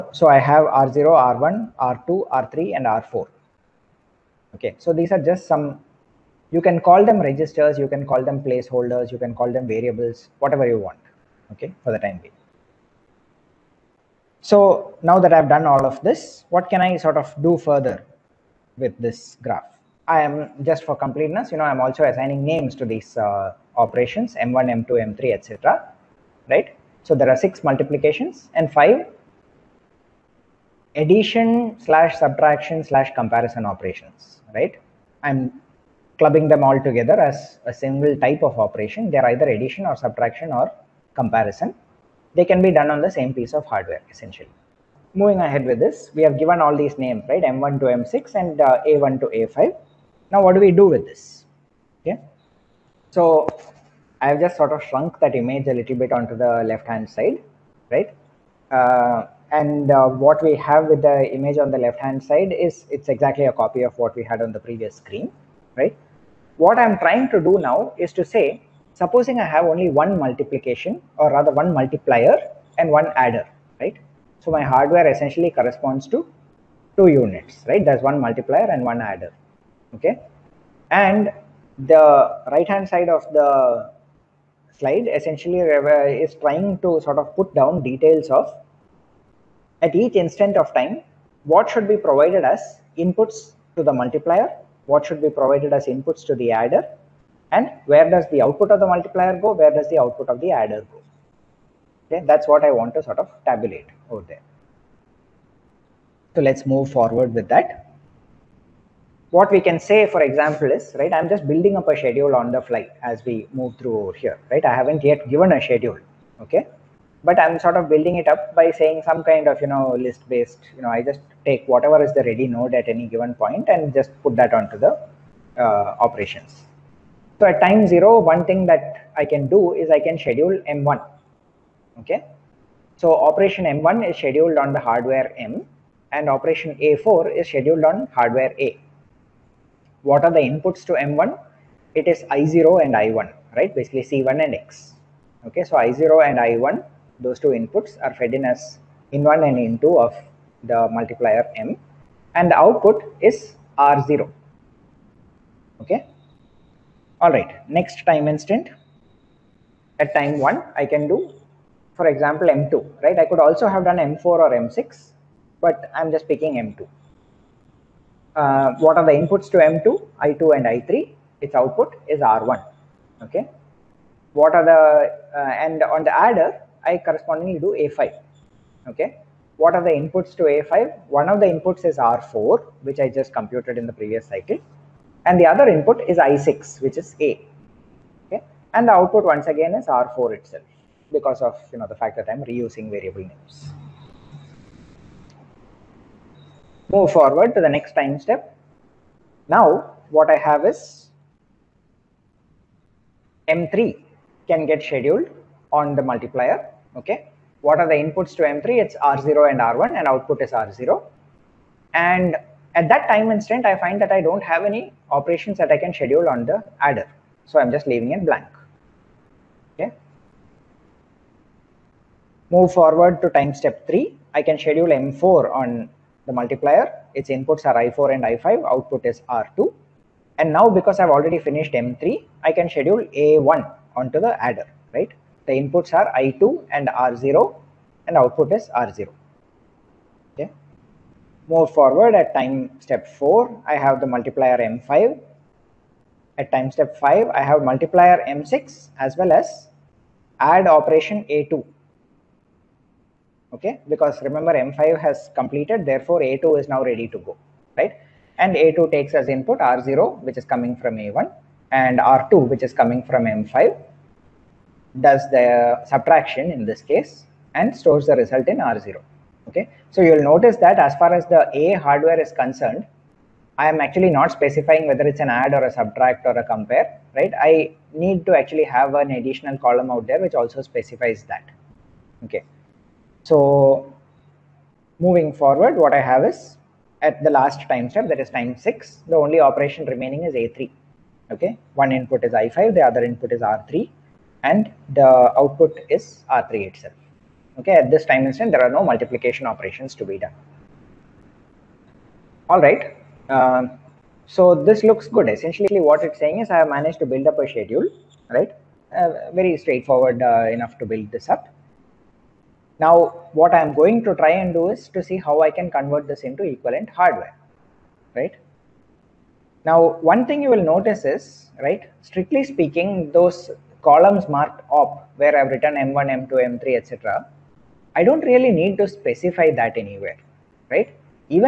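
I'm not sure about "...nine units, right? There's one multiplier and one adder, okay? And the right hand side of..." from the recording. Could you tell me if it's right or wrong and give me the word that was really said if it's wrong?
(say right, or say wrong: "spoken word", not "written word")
wrong: "two", not "nine".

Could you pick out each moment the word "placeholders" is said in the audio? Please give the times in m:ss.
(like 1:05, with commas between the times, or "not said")
0:08.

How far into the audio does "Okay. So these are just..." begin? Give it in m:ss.
0:04.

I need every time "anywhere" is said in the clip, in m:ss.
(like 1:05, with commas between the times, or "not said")
5:29.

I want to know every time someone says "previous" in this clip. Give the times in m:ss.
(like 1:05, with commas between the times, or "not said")
1:04, 3:03.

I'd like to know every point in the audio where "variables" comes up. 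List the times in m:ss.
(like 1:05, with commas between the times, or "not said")
0:09, 3:12.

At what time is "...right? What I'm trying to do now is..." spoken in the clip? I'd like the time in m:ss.
1:05.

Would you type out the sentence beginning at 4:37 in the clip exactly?
I need to actually have an additional column out there which also specifies that.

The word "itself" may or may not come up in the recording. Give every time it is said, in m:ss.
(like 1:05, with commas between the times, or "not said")
3:10, 4:56.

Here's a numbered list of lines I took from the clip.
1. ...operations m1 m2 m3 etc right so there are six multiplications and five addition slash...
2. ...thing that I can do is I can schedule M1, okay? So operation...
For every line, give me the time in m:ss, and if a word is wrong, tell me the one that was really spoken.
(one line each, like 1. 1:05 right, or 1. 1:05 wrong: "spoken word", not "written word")
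1. 0:23 right
2. 2:08 right.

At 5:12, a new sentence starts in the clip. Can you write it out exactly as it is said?
Now, what I'm going to try and do is to see how I can convert this into equivalent hardware, right?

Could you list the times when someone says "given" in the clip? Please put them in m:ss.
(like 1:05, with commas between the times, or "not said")
0:46, 1:55, 2:03.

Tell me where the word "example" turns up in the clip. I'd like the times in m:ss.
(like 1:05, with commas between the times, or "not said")
1:50, 2:42.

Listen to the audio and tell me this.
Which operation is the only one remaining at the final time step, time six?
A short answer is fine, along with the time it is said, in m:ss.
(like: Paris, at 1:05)
A3, at 4:50.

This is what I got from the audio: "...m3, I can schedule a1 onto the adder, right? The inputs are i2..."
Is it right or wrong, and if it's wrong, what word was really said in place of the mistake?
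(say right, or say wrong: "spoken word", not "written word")
right.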